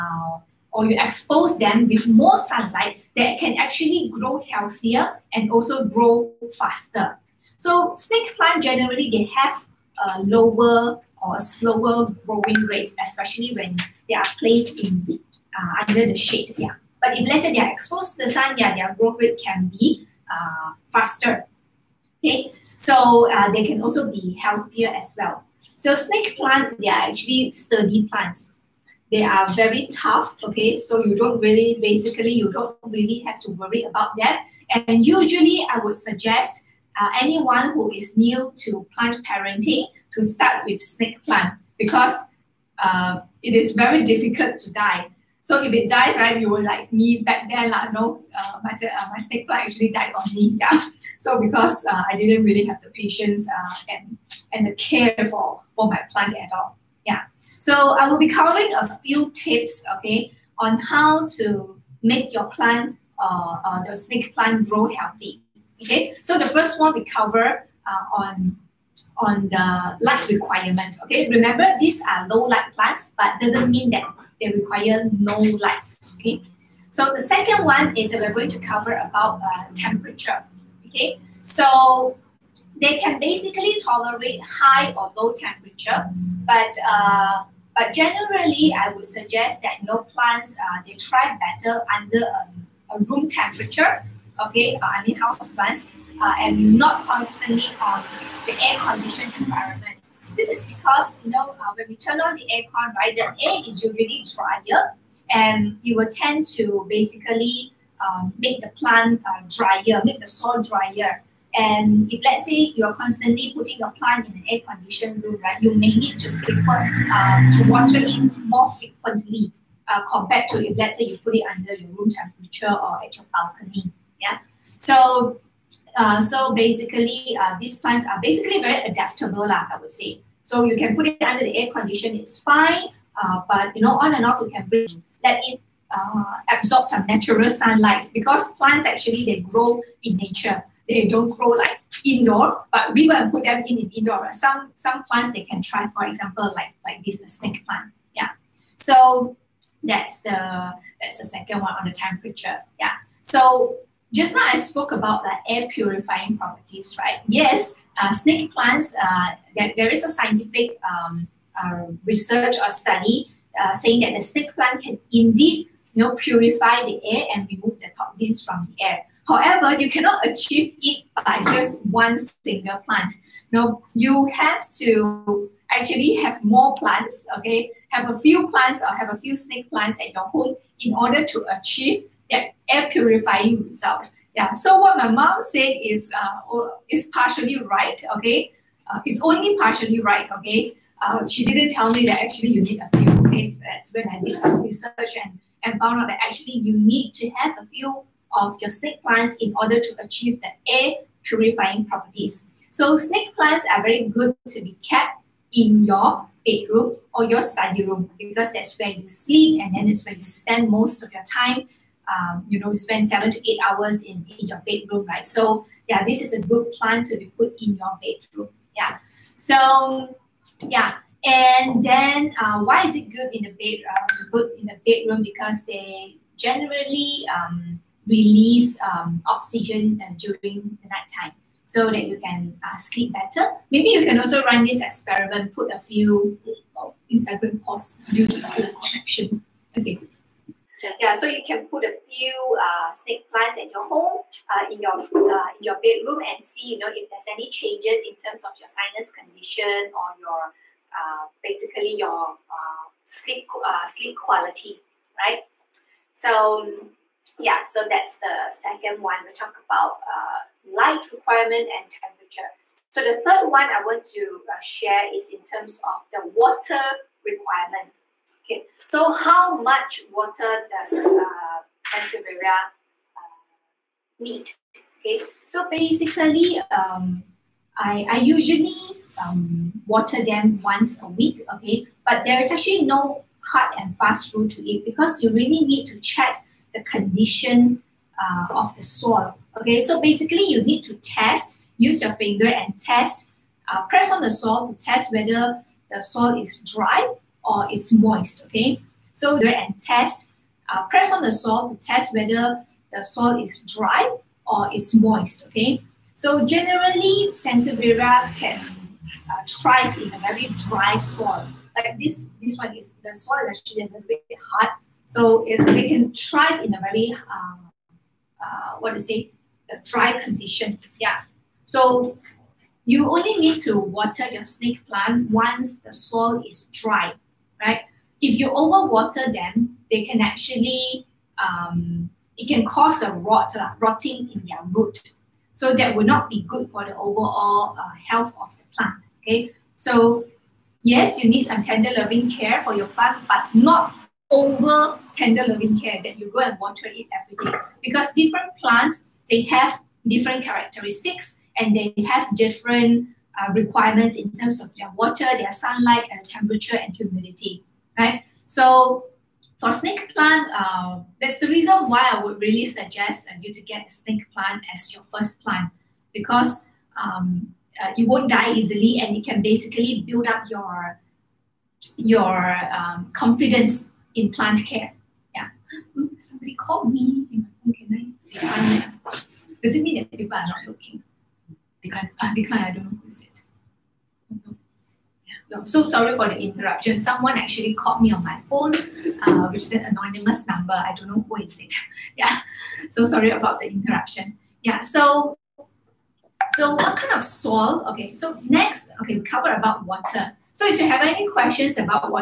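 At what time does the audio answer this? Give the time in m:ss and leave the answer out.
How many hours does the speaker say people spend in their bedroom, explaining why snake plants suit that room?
3:33.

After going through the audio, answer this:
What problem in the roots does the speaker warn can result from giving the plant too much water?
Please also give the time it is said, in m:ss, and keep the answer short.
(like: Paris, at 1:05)
Rotting, at 5:33.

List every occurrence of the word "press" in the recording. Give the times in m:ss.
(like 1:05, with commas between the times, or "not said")
4:53, 5:00.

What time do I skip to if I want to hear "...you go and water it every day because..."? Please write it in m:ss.
5:46.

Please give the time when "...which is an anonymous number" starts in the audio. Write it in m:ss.
6:29.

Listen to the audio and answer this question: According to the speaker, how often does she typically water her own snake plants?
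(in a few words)
Once a week.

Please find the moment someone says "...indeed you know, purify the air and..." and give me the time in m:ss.
2:45.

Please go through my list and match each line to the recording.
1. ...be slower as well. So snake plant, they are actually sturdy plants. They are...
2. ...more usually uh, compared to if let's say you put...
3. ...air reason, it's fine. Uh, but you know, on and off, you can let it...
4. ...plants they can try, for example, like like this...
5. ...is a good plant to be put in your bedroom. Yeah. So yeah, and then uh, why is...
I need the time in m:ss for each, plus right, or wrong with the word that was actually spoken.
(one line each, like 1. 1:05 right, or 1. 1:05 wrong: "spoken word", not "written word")
1. 0:24 wrong: "healthier", not "slower"
2. 1:58 wrong: "frequently", not "usually"
3. 2:11 wrong: "condition", not "reason"
4. 2:25 right
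5. 3:36 right.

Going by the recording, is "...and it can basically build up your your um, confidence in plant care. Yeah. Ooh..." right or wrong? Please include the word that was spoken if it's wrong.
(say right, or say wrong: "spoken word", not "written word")
right.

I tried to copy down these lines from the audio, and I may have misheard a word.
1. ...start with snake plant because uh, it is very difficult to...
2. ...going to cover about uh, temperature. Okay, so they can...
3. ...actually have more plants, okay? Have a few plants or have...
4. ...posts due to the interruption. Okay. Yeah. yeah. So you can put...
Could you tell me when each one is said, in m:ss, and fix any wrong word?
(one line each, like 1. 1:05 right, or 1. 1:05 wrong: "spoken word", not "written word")
1. 0:40 right
2. 1:18 right
3. 2:55 right
4. 3:57 wrong: "connection", not "interruption".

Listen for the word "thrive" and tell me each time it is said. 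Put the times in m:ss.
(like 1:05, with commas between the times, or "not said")
1:30, 5:09, 5:16.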